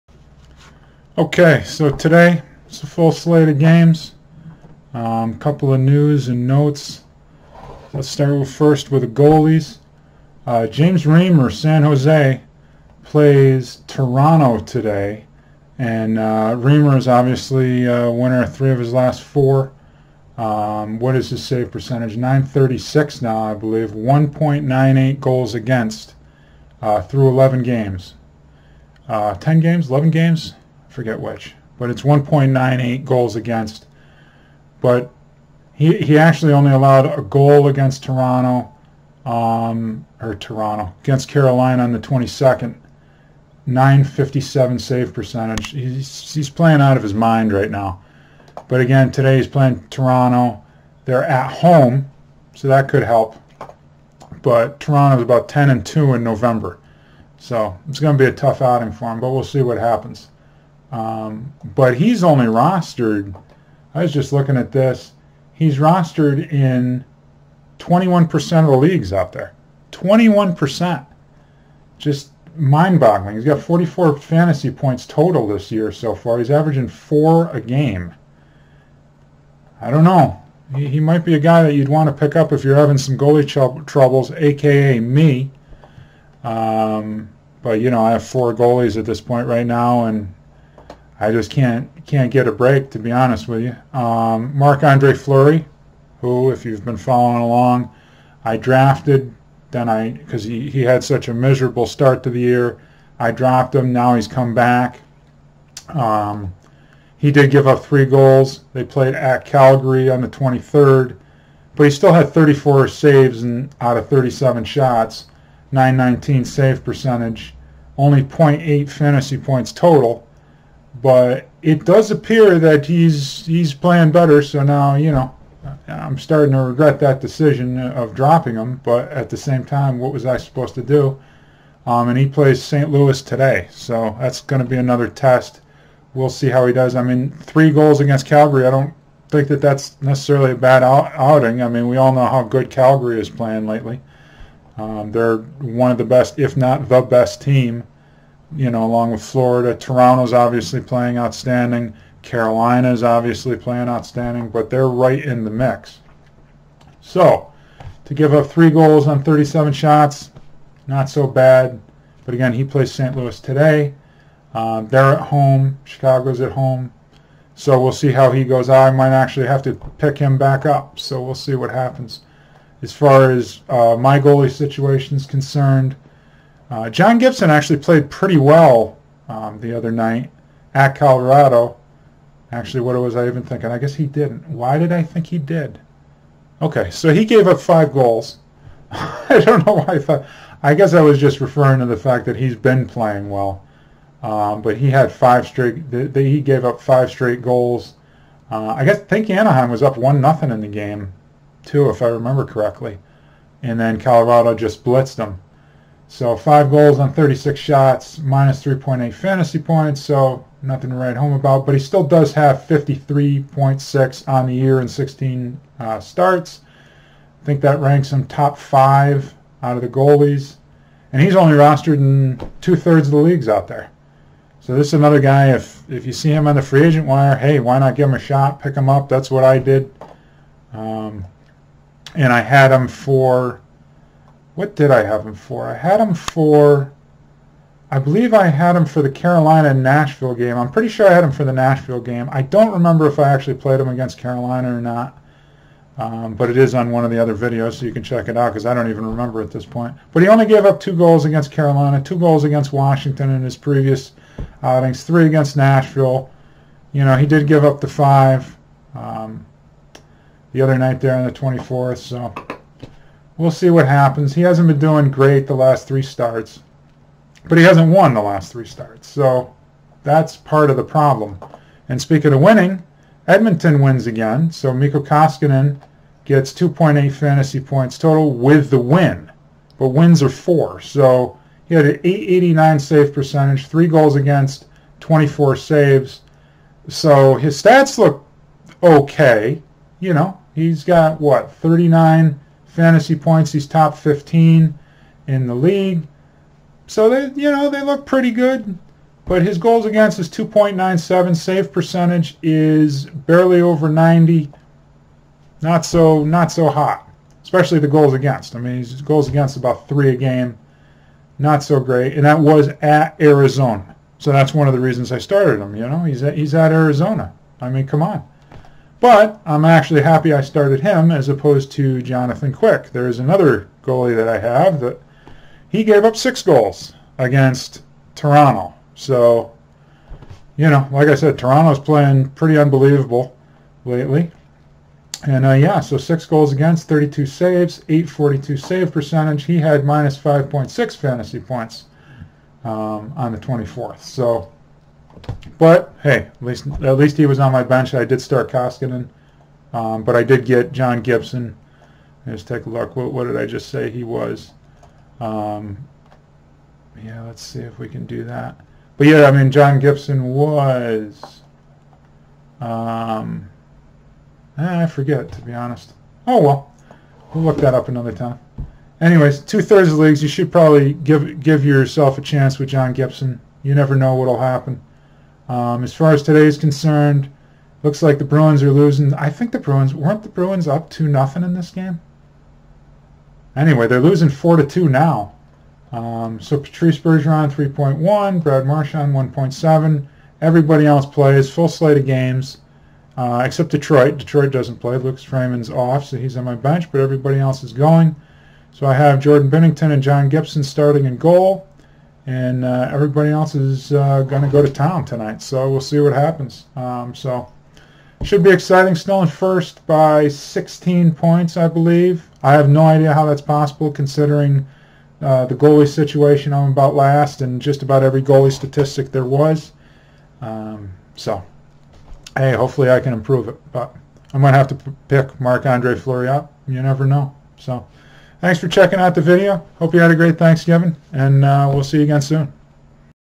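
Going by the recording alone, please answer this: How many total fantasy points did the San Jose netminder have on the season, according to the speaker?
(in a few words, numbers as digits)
44.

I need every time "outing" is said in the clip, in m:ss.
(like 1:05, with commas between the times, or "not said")
0:58, 2:20, 4:14.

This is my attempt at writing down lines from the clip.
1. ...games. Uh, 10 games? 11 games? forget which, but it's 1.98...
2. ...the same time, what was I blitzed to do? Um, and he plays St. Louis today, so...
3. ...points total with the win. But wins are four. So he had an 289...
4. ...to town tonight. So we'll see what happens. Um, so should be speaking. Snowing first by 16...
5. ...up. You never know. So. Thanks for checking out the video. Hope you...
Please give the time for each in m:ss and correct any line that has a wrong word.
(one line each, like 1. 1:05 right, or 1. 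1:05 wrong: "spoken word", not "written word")
1. 0:27 right
2. 2:09 wrong: "supposed", not "blitzed"
3. 4:37 wrong: "889", not "289"
4. 6:44 wrong: "exciting", not "speaking"
5. 7:06 right.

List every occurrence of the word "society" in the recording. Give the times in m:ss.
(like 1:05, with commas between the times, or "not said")
not said.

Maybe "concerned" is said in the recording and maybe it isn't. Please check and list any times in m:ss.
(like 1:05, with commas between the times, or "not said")
2:55, 6:16.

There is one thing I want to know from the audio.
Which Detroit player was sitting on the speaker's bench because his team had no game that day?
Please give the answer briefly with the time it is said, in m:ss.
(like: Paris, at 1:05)
Lucas Raymond, at 6:34.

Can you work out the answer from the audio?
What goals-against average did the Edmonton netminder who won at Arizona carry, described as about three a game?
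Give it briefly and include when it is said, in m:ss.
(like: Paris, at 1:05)
2.97, at 5:00.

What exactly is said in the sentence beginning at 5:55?
Um, yeah, let's see if we can do that.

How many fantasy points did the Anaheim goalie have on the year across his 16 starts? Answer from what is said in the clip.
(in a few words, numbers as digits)
53.6.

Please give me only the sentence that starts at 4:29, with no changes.
So that's part of the problem.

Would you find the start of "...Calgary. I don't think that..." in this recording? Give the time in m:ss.
2:18.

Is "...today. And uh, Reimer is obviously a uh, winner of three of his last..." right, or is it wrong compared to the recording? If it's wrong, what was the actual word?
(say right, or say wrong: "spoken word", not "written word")
right.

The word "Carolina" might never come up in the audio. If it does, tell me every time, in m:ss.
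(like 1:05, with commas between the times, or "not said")
0:41, 2:32, 3:59, 4:04, 4:11.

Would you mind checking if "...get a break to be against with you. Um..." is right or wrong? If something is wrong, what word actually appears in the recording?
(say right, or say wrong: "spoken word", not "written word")
wrong: "honest", not "against".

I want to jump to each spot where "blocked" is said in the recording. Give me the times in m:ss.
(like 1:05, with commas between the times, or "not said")
not said.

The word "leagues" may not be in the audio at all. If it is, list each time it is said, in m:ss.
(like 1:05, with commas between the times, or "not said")
1:08, 3:43, 4:55, 6:09.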